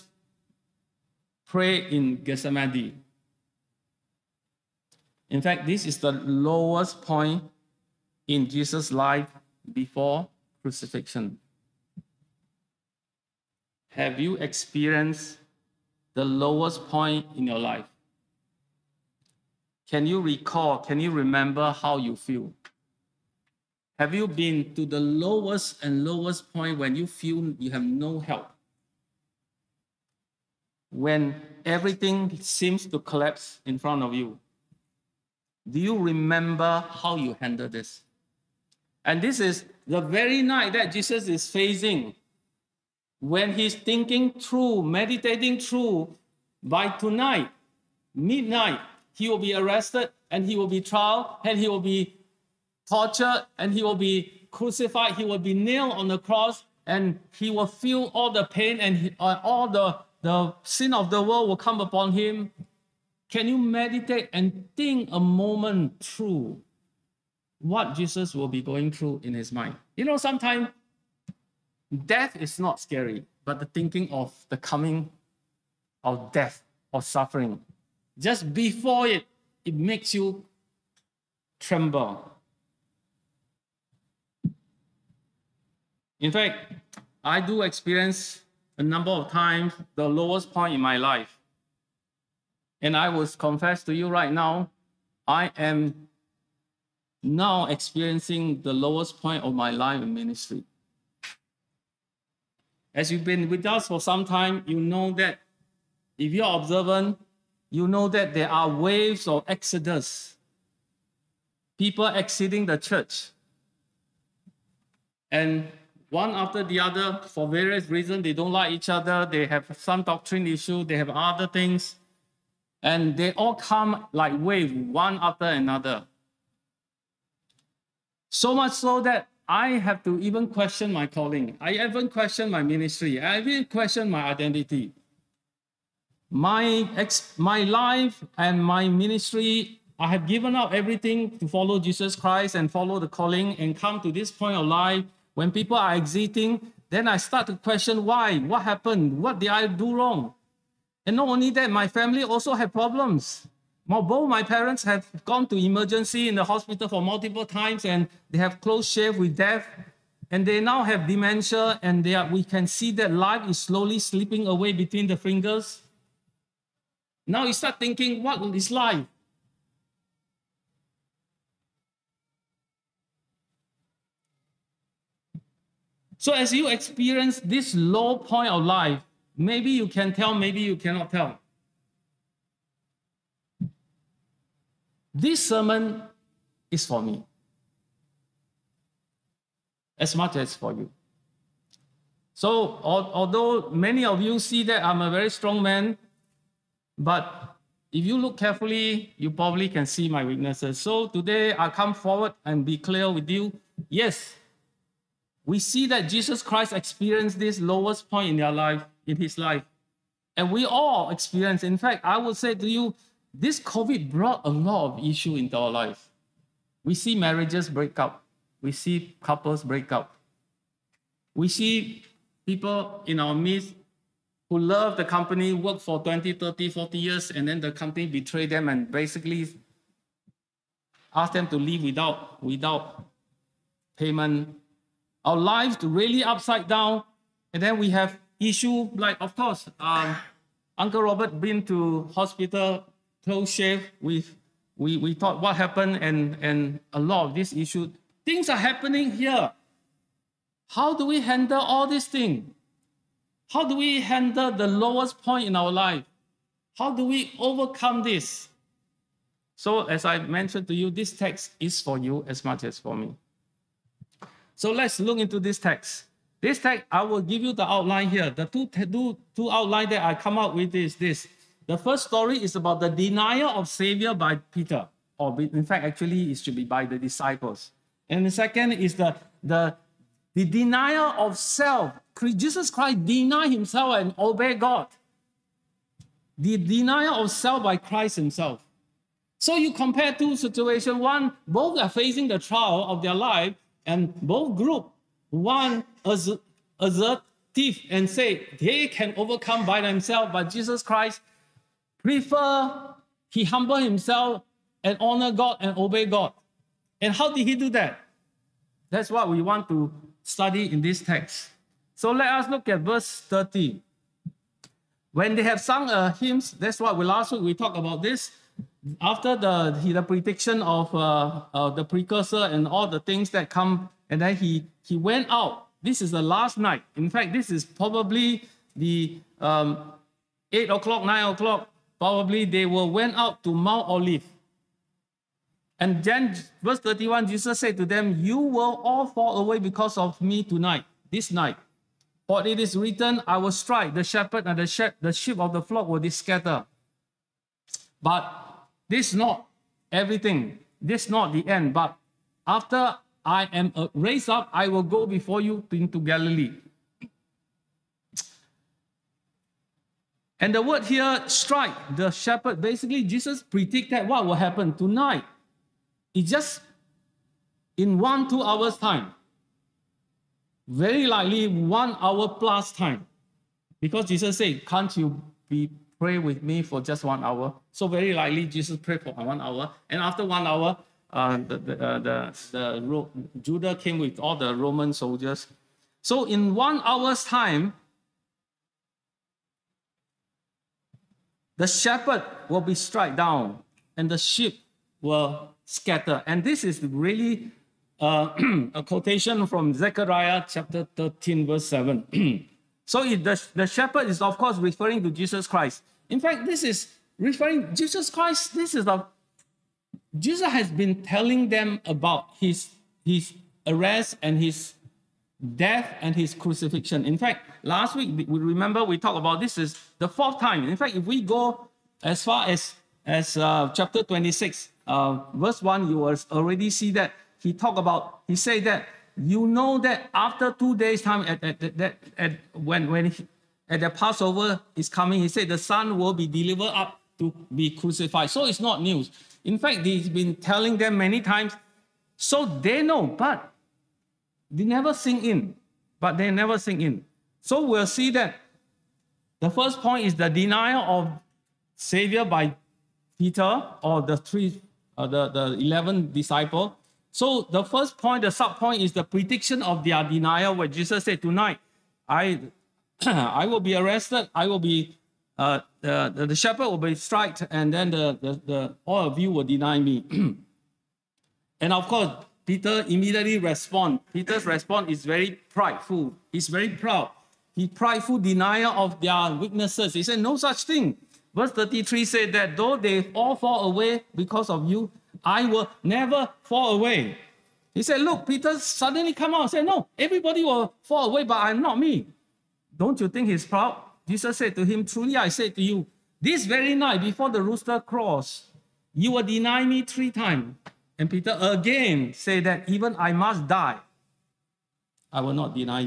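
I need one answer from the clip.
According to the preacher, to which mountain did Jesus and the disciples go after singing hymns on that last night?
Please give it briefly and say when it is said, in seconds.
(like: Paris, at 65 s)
Mount Olive, at 333 s.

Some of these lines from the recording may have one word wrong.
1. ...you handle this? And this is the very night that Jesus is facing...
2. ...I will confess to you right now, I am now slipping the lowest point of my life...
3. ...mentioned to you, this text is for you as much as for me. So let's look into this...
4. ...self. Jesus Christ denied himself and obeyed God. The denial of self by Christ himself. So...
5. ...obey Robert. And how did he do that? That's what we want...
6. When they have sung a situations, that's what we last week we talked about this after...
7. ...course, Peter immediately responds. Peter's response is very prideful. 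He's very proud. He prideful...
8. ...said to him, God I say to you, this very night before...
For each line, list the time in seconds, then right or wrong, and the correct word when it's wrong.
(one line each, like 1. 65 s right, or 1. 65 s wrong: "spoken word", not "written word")
1. 37 s right
2. 92 s wrong: "experiencing", not "slipping"
3. 260 s right
4. 281 s right
5. 305 s wrong: "God", not "Robert"
6. 315 s wrong: "hymns", not "situations"
7. 471 s right
8. 494 s wrong: "Truly", not "God".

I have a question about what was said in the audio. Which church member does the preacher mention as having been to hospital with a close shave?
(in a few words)
Uncle Robert.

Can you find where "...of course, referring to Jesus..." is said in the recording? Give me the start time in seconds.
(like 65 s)
404 s.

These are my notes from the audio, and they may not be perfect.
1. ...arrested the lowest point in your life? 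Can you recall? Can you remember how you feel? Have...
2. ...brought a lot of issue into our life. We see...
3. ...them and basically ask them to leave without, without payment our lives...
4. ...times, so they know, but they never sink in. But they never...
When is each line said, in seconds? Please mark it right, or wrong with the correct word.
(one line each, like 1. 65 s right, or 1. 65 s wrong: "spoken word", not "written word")
1. 14 s wrong: "experienced", not "arrested"
2. 214 s right
3. 228 s right
4. 441 s right.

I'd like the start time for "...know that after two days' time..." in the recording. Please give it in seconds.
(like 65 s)
429 s.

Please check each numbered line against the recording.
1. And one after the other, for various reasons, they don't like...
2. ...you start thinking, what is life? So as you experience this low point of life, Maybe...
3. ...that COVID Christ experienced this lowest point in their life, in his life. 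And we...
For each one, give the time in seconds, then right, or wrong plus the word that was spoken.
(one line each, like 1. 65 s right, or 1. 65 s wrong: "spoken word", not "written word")
1. 115 s right
2. 167 s right
3. 205 s wrong: "Jesus", not "COVID".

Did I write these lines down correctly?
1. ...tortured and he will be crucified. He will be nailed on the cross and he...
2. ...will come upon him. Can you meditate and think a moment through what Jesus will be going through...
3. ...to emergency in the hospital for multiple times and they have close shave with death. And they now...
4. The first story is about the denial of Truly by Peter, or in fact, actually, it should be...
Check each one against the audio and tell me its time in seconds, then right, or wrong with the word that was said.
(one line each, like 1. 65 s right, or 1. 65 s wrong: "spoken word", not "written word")
1. 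52 s right
2. 61 s right
3. 155 s right
4. 271 s wrong: "Savior", not "Truly".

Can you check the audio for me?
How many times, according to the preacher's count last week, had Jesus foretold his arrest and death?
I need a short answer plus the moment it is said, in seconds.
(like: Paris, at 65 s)
4, at 420 s.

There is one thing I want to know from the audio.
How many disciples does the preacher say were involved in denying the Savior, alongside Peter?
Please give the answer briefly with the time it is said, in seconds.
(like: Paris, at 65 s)
11, at 455 s.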